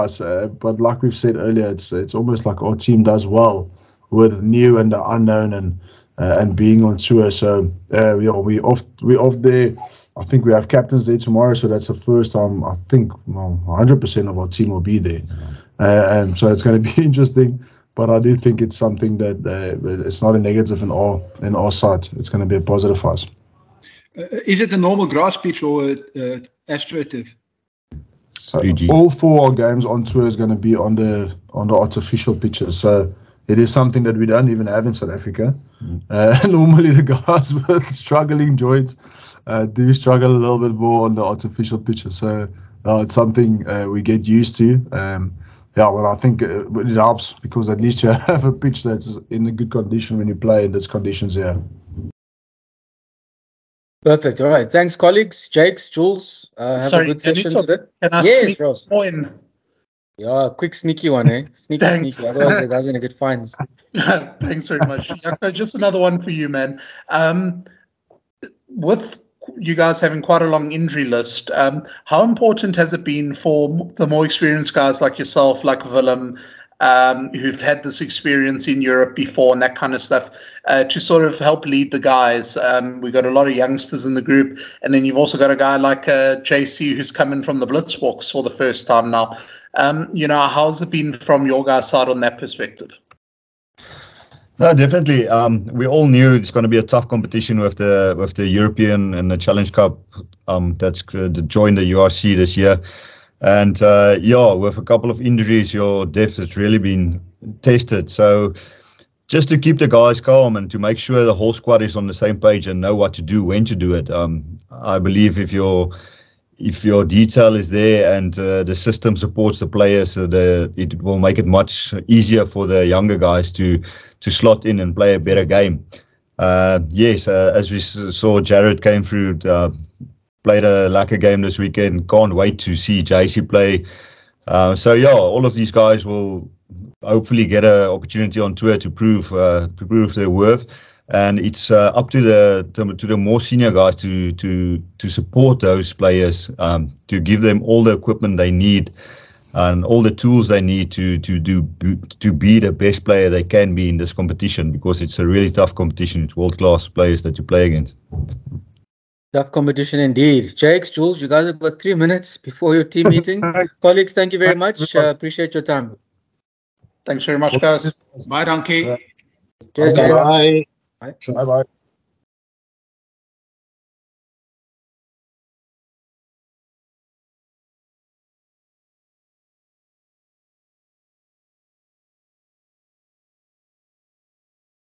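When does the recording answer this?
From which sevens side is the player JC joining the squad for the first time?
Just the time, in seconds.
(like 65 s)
87 s.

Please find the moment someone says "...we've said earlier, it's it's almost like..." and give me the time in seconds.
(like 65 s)
1 s.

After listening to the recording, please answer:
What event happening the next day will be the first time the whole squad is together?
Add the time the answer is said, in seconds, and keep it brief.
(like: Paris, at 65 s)
Captain's Day, at 10 s.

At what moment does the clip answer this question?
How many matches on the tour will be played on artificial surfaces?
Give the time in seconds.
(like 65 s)
28 s.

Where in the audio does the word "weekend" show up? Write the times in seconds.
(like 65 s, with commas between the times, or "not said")
131 s.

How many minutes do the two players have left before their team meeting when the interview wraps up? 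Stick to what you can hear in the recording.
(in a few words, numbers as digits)
3.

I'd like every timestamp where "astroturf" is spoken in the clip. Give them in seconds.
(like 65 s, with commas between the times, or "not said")
26 s.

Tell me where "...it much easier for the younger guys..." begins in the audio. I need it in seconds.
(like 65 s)
121 s.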